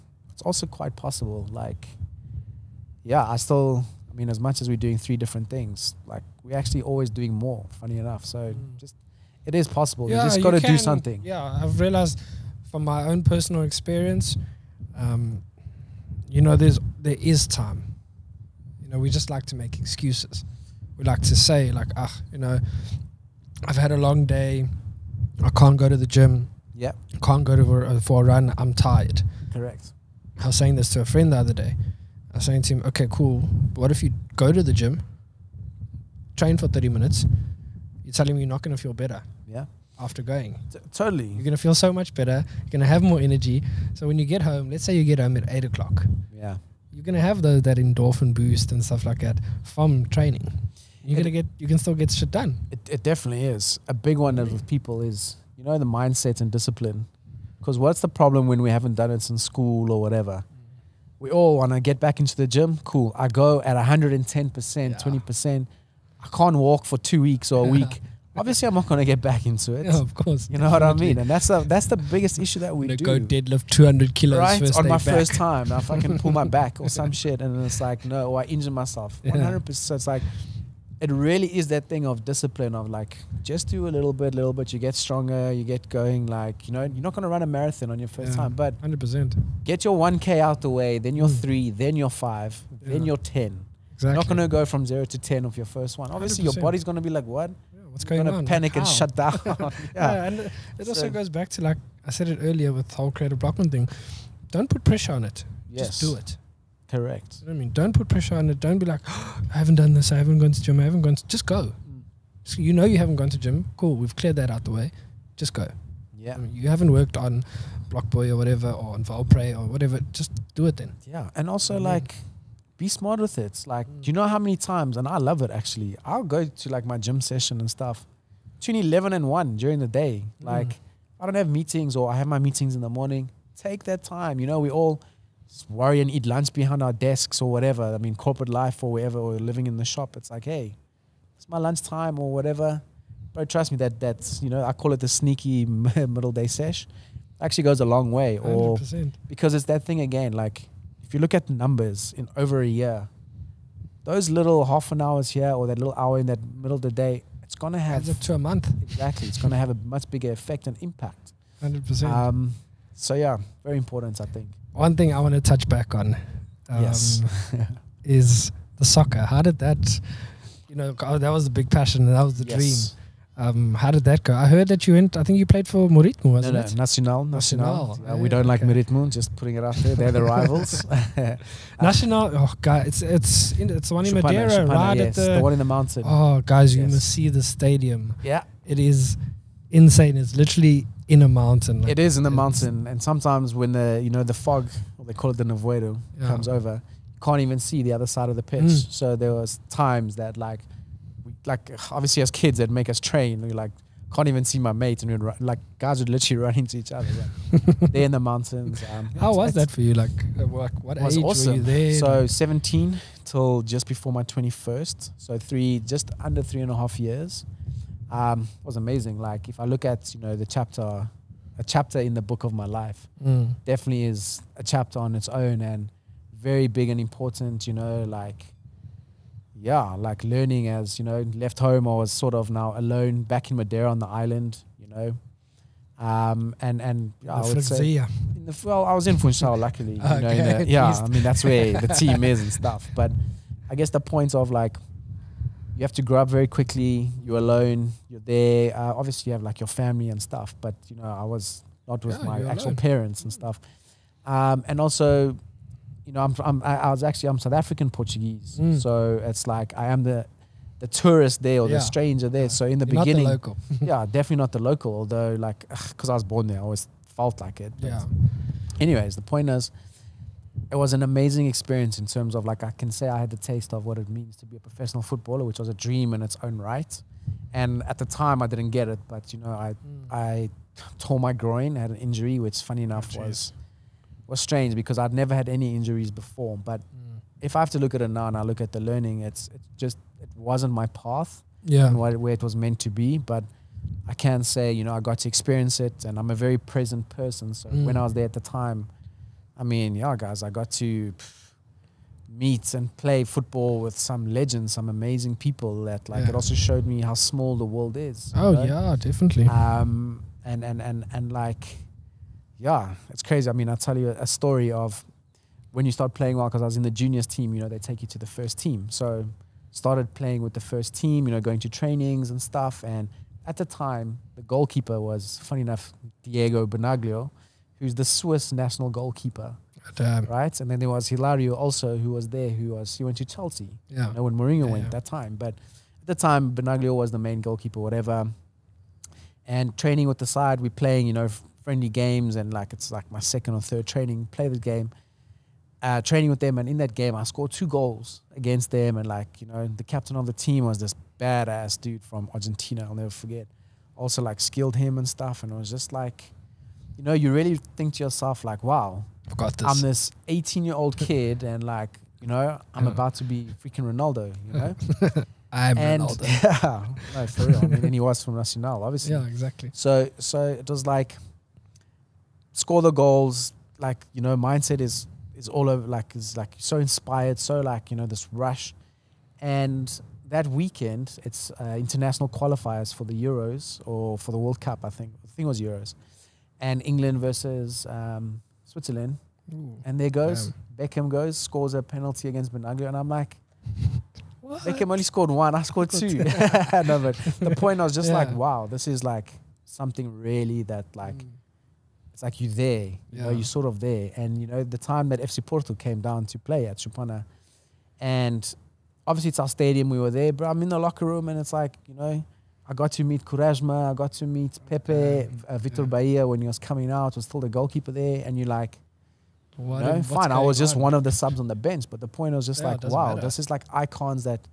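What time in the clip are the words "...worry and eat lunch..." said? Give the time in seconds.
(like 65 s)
135 s.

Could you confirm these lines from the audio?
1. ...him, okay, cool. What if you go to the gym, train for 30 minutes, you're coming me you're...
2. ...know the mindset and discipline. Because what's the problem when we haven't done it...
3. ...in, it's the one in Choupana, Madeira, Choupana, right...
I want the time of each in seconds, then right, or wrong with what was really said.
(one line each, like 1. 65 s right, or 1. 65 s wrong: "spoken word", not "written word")
1. 32 s wrong: "telling", not "coming"
2. 55 s right
3. 183 s right.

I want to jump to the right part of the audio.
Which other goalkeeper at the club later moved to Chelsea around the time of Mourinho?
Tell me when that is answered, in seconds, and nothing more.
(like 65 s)
331 s.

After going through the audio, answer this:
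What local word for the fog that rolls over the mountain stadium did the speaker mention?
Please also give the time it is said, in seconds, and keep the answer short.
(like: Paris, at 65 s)
nevoeiro, at 195 s.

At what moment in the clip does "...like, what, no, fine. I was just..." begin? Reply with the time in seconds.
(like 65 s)
418 s.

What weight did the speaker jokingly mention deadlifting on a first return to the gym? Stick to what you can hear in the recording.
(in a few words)
200 kilos.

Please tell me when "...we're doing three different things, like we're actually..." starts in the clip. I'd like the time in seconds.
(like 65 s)
4 s.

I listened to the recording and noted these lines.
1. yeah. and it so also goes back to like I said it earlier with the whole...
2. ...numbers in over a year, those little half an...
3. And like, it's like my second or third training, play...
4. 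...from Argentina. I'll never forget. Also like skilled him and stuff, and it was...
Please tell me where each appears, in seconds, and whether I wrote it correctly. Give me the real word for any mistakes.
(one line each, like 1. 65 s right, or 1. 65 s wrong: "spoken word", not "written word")
1. 99 s right
2. 151 s right
3. 342 s right
4. 352 s right.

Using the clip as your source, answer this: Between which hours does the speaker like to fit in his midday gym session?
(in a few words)
11 and 1.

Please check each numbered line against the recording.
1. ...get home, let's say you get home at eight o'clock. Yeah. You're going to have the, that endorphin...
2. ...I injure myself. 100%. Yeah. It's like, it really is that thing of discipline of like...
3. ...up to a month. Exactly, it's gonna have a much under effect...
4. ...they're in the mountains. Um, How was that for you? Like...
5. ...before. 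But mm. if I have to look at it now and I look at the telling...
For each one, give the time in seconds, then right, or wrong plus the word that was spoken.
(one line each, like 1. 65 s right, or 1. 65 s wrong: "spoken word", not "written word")
1. 44 s right
2. 78 s right
3. 158 s wrong: "bigger", not "under"
4. 207 s right
5. 286 s wrong: "learning", not "telling".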